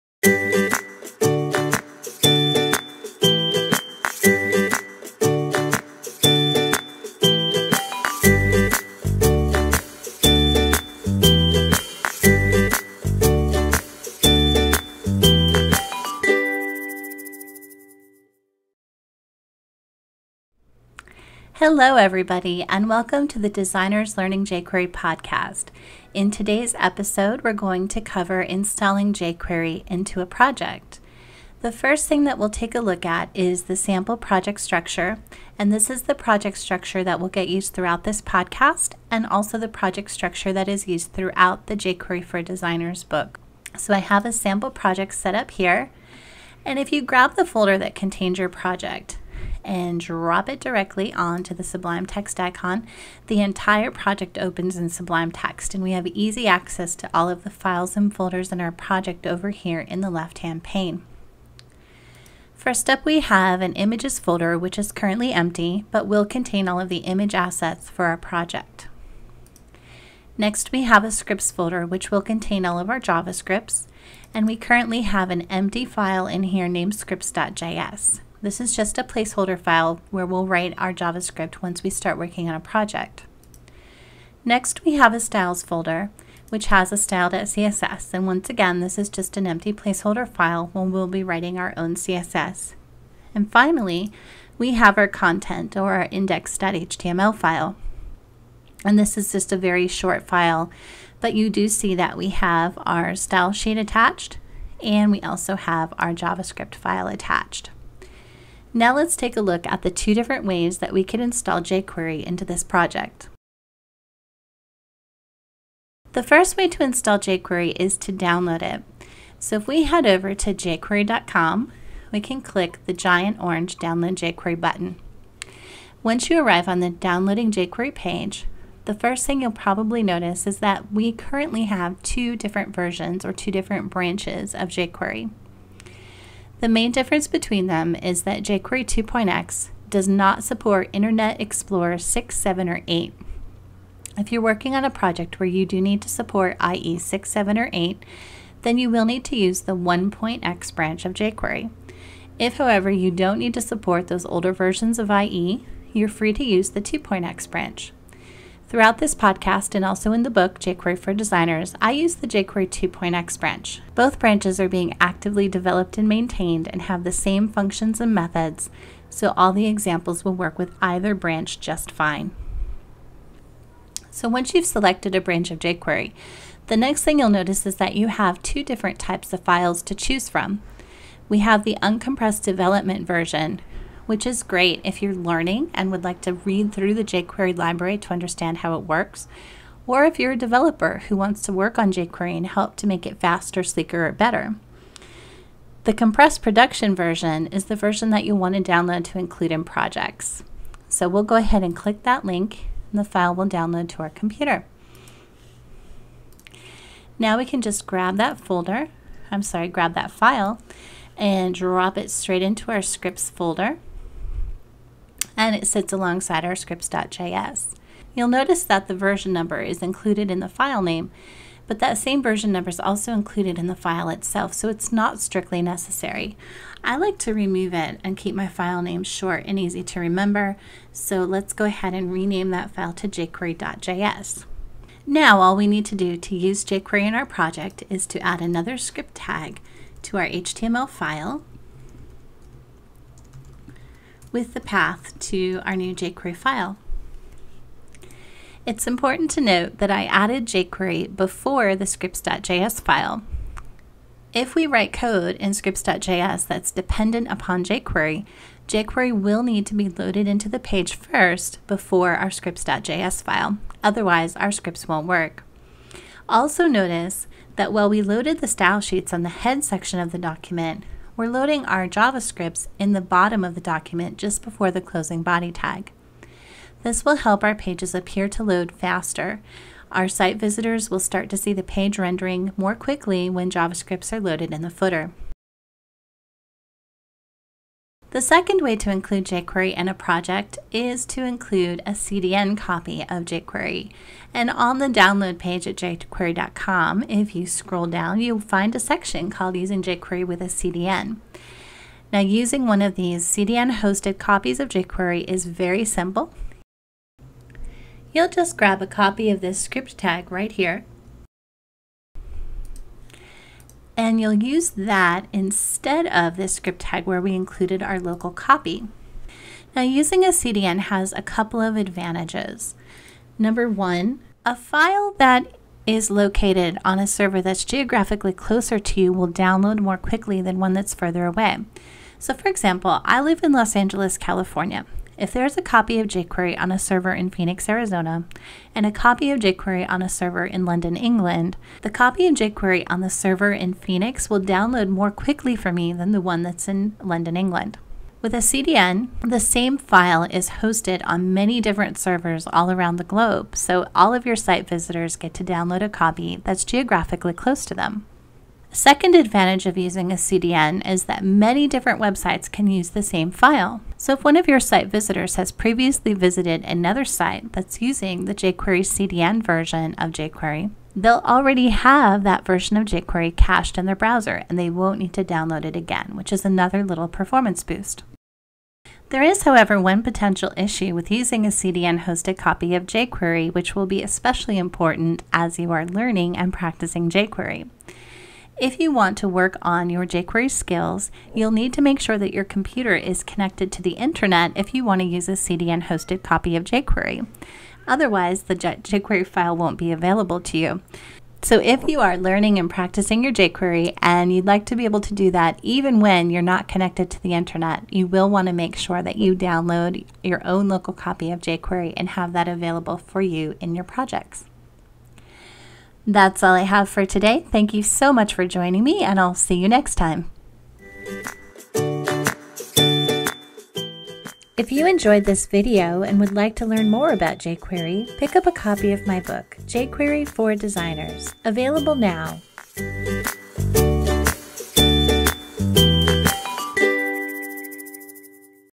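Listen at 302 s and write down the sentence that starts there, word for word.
Now, using one of these CDN hosted copies of jQuery is very simple.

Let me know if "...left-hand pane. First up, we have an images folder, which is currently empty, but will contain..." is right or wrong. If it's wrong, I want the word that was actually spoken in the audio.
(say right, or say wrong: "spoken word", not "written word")
right.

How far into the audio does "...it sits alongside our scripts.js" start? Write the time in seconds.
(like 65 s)
215 s.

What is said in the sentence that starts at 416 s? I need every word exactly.
That's all I have for today.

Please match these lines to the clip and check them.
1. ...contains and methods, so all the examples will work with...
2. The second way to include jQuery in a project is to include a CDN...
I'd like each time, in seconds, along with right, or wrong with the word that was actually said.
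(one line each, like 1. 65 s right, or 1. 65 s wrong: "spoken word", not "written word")
1. 167 s wrong: "functions", not "contains"
2. 288 s right.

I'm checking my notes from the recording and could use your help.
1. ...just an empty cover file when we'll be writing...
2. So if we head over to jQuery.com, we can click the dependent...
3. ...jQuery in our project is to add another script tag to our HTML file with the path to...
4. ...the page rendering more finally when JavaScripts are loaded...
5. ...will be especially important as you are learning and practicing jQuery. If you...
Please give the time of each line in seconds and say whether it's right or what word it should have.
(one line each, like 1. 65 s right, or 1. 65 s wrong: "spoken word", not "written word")
1. 89 s wrong: "placeholder", not "cover"
2. 119 s wrong: "giant", not "dependent"
3. 236 s right
4. 281 s wrong: "quickly", not "finally"
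5. 383 s right.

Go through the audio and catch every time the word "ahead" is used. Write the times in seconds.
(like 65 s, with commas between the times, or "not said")
201 s, 231 s.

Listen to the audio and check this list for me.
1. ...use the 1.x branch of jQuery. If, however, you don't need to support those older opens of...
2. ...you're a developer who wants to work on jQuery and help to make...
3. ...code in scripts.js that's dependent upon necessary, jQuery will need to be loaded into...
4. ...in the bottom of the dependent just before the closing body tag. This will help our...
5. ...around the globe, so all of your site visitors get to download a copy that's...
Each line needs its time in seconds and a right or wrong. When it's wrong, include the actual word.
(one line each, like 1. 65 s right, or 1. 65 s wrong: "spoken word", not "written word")
1. 149 s wrong: "versions", not "opens"
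2. 190 s right
3. 254 s wrong: "jQuery", not "necessary"
4. 272 s wrong: "document", not "dependent"
5. 352 s right.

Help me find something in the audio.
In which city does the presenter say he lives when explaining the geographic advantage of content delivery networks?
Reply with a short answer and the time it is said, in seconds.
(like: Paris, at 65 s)
Los Angeles, at 333 s.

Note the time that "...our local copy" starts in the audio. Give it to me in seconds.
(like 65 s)
317 s.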